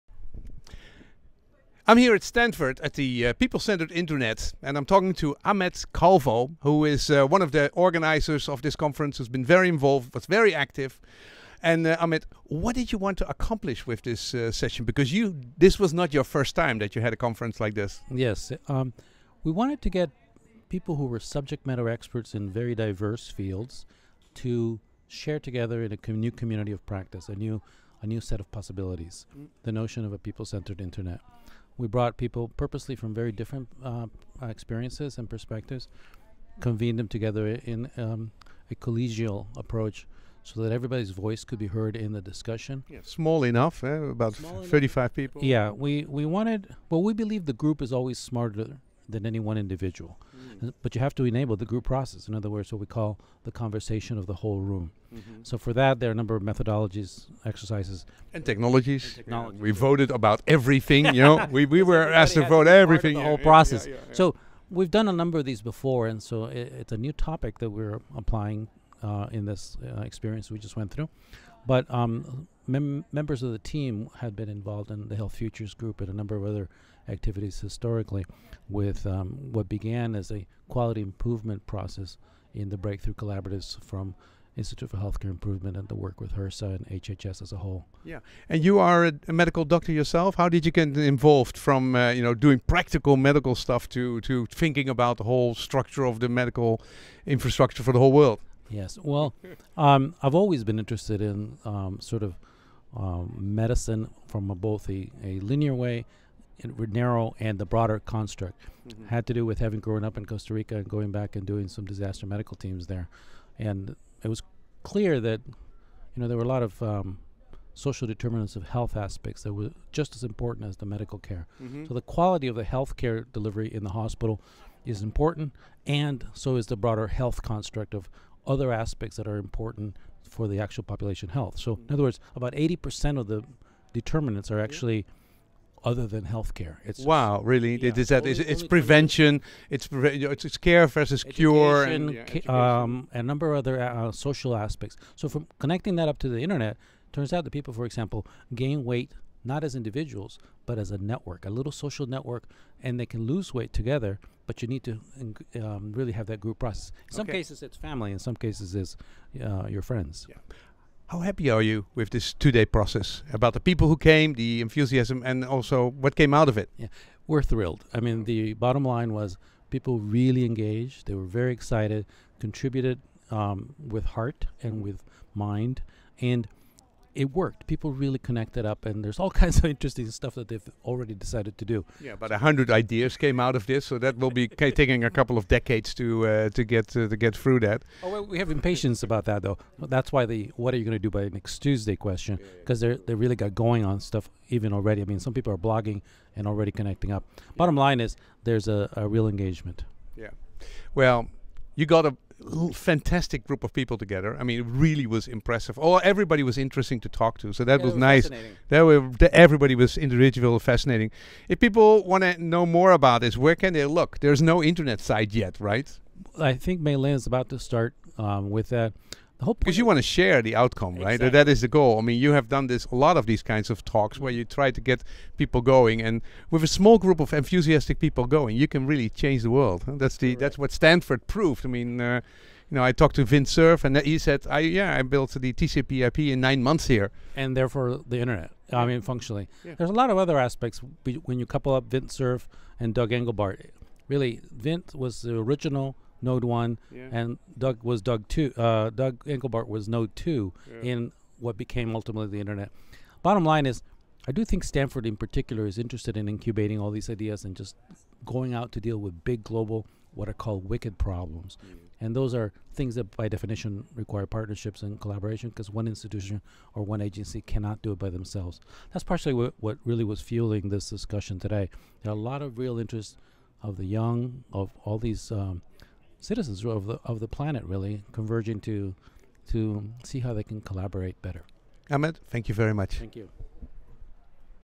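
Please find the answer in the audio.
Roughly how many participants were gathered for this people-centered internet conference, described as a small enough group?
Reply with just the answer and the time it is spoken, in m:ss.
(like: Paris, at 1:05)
35, at 0:44.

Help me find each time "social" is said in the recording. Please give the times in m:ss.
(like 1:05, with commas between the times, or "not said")
1:57, 2:24, 2:31.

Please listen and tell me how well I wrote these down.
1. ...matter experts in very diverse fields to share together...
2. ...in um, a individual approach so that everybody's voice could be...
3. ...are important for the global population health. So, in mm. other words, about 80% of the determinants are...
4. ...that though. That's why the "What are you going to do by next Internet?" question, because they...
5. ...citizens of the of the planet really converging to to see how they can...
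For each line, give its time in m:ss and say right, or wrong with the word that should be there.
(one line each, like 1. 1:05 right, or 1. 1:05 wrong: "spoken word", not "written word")
1. 0:21 right
2. 0:37 wrong: "collegial", not "individual"
3. 2:09 wrong: "actual", not "global"
4. 3:09 wrong: "Tuesday", not "Internet"
5. 4:36 right.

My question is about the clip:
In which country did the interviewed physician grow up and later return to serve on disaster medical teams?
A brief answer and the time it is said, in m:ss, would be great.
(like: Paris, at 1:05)
Costa Rica, at 1:50.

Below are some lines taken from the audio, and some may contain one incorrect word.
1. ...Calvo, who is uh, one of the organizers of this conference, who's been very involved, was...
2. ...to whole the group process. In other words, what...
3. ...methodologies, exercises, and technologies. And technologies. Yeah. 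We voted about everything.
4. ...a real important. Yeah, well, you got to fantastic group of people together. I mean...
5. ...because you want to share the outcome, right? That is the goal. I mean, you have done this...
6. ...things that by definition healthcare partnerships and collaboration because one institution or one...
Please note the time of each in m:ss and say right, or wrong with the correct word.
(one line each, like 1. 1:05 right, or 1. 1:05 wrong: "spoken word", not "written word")
1. 0:05 right
2. 0:51 wrong: "enable", not "whole"
3. 0:56 right
4. 3:18 wrong: "engagement", not "important"
5. 3:39 right
6. 4:22 wrong: "require", not "healthcare".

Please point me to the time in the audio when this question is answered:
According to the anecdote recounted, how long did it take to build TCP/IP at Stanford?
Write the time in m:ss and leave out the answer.
3:56.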